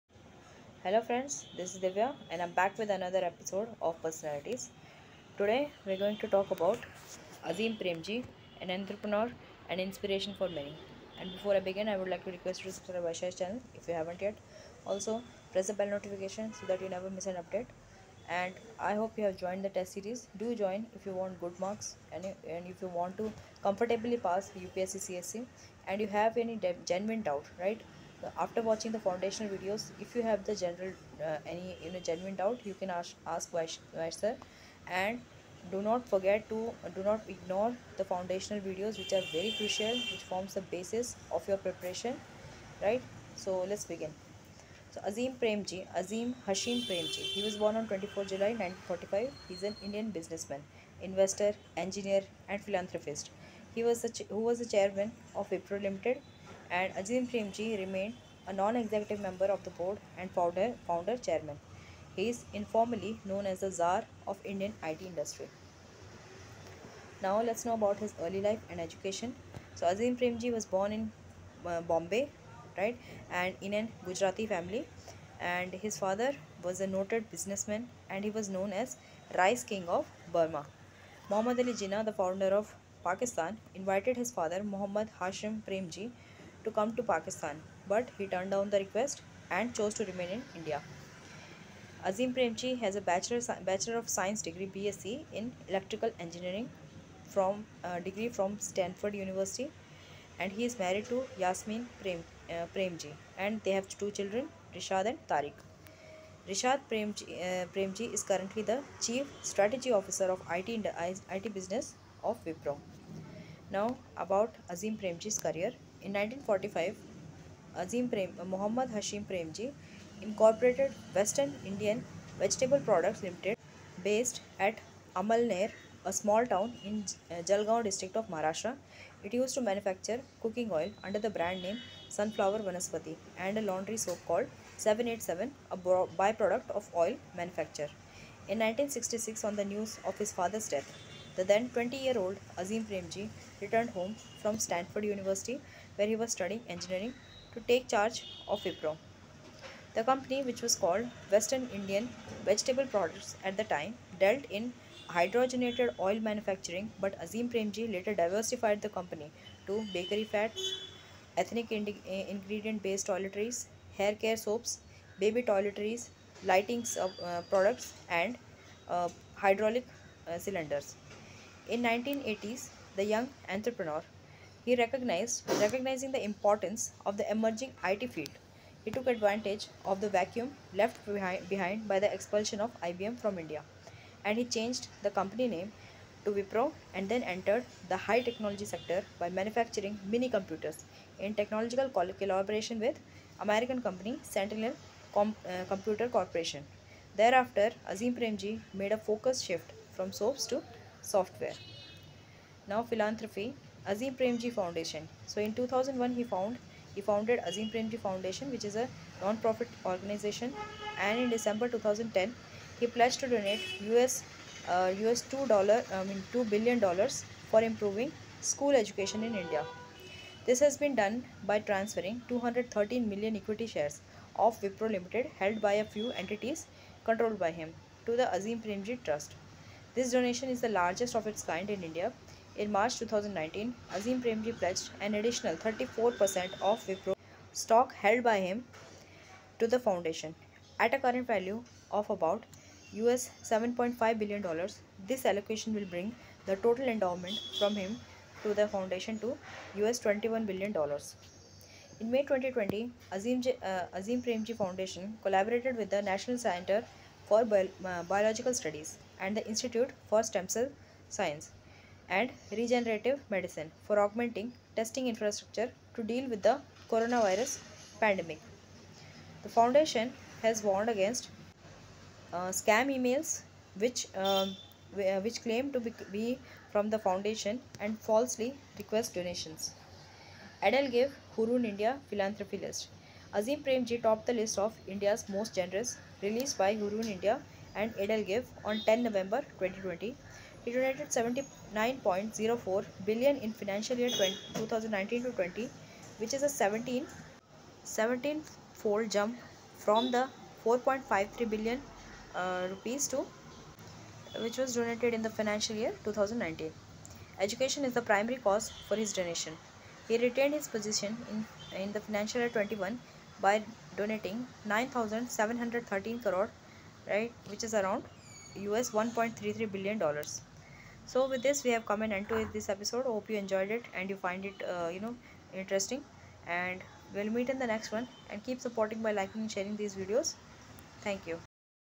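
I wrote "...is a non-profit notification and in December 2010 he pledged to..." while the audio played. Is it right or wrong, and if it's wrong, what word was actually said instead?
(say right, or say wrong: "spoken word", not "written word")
wrong: "organization", not "notification".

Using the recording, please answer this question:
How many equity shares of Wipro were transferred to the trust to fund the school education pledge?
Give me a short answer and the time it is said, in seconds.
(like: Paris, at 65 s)
213 million, at 222 s.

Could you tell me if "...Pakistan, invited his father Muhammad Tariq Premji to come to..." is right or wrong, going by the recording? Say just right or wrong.
wrong.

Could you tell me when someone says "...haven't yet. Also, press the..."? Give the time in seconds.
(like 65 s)
13 s.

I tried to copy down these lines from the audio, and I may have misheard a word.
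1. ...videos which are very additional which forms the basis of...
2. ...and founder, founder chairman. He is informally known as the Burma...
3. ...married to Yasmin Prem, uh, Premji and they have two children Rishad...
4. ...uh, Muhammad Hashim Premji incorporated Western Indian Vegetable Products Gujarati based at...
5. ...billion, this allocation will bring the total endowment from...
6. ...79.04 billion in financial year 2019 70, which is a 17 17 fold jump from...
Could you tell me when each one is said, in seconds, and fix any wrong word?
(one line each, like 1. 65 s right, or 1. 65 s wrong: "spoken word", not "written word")
1. 38 s wrong: "crucial", not "additional"
2. 60 s wrong: "Czar", not "Burma"
3. 100 s right
4. 118 s wrong: "Limited", not "Gujarati"
5. 244 s right
6. 291 s wrong: "20", not "70".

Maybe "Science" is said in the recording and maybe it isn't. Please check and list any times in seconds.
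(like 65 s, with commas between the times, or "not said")
94 s, 261 s.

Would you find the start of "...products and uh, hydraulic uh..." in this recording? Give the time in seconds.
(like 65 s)
167 s.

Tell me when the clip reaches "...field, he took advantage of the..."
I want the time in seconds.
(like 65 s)
178 s.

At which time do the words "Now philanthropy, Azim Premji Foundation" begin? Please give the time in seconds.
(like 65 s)
202 s.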